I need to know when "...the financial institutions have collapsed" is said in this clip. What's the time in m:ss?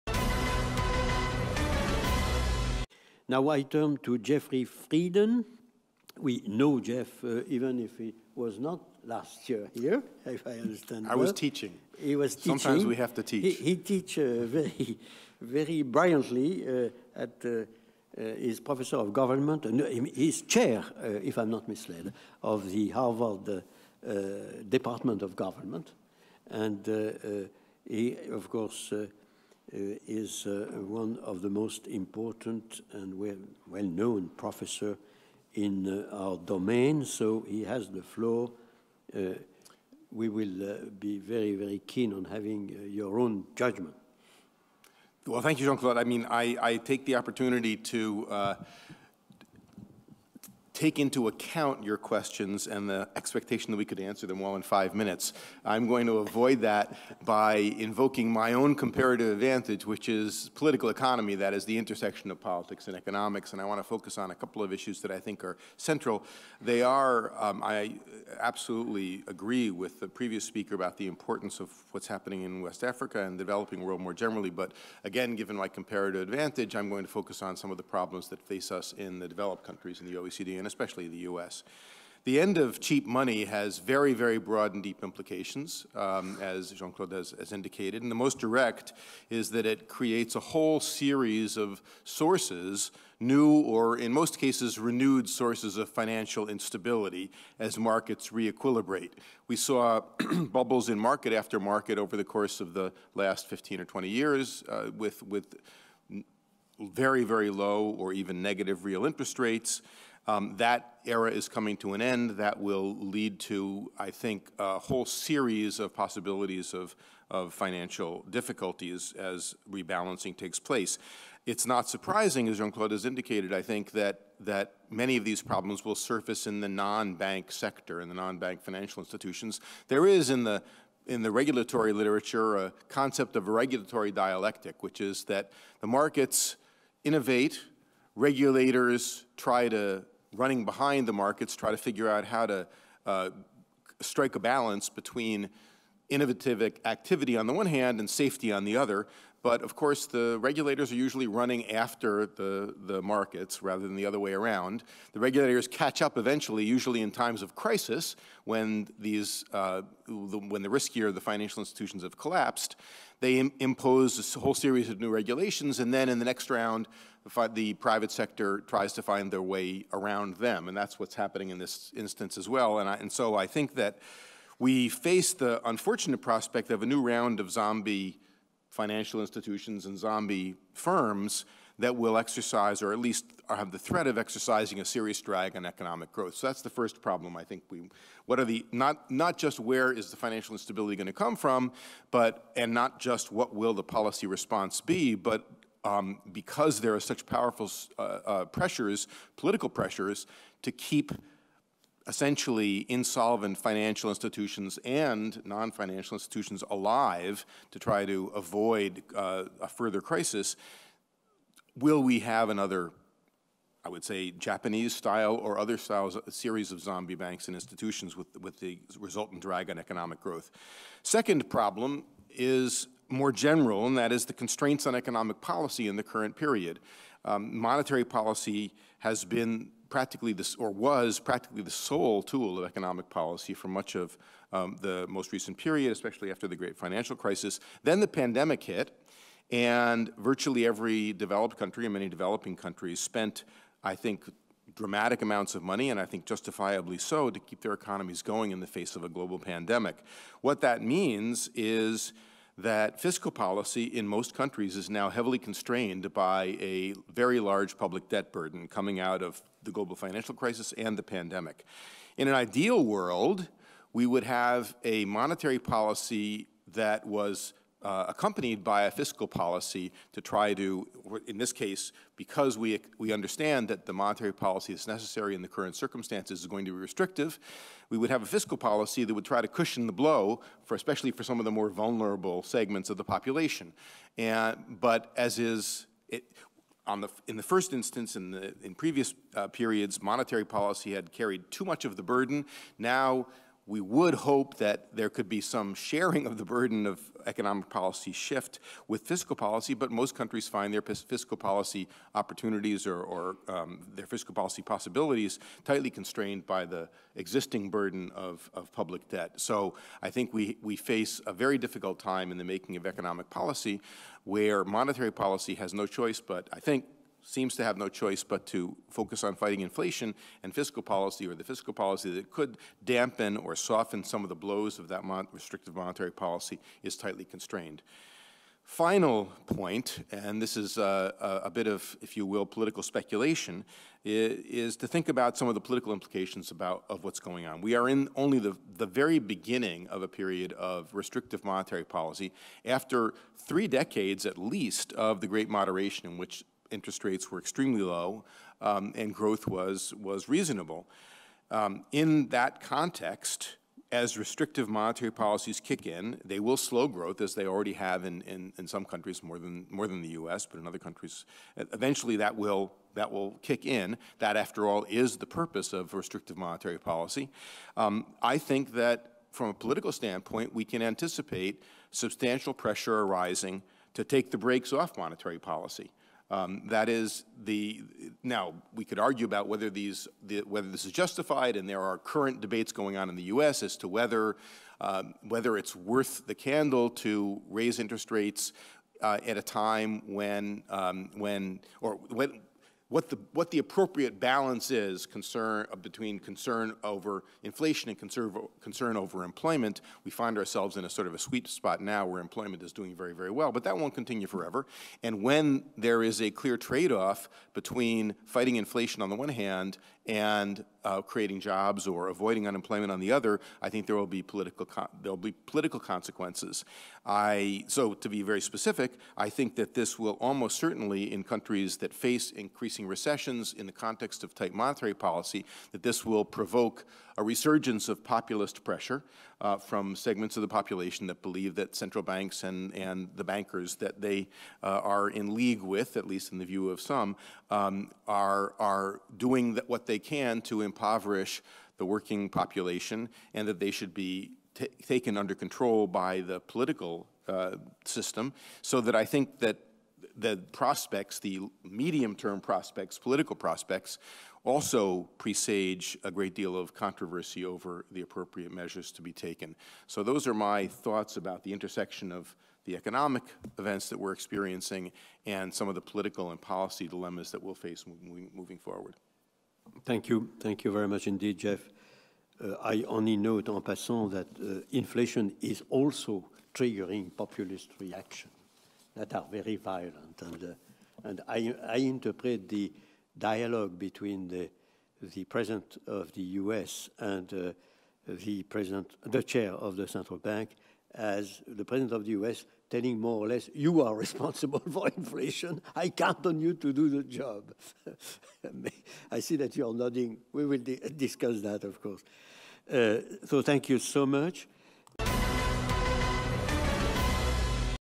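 2:41.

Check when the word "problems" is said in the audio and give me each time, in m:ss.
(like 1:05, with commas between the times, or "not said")
1:17, 2:05, 3:07, 3:41.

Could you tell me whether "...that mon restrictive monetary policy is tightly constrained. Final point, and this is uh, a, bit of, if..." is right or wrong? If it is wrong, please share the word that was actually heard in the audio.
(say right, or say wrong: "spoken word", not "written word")
right.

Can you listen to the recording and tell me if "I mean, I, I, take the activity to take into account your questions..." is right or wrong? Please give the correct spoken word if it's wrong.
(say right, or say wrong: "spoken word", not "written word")
wrong: "opportunity", not "activity".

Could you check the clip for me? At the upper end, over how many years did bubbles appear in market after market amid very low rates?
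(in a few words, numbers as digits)
20.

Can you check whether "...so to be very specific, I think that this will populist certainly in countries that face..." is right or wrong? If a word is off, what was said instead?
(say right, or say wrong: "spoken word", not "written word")
wrong: "almost", not "populist".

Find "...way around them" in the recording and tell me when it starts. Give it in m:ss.
2:49.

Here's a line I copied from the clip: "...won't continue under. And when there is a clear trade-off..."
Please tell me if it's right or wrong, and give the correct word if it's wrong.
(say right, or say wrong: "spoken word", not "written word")
wrong: "forever", not "under".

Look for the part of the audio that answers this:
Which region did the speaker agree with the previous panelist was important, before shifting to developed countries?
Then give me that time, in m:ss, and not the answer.
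1:12.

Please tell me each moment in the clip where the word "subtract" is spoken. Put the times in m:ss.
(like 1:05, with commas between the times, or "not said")
not said.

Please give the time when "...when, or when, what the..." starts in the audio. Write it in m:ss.
6:31.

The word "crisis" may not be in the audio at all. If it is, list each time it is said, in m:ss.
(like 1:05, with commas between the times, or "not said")
2:37, 3:30, 3:57, 4:20.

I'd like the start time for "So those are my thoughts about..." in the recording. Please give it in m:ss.
7:39.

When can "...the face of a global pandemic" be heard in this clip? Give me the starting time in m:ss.
4:08.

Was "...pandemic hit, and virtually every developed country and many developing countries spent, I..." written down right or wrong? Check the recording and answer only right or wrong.
right.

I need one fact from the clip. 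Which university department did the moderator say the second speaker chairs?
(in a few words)
Harvard Department of Government.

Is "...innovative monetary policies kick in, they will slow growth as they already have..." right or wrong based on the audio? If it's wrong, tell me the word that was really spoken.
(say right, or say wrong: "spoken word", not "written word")
wrong: "restrictive", not "innovative".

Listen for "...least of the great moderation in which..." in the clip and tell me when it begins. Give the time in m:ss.
5:44.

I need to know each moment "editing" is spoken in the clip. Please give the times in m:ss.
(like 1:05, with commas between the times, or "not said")
not said.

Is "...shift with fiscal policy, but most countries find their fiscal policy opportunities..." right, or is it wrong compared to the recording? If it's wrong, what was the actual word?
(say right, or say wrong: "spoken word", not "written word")
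right.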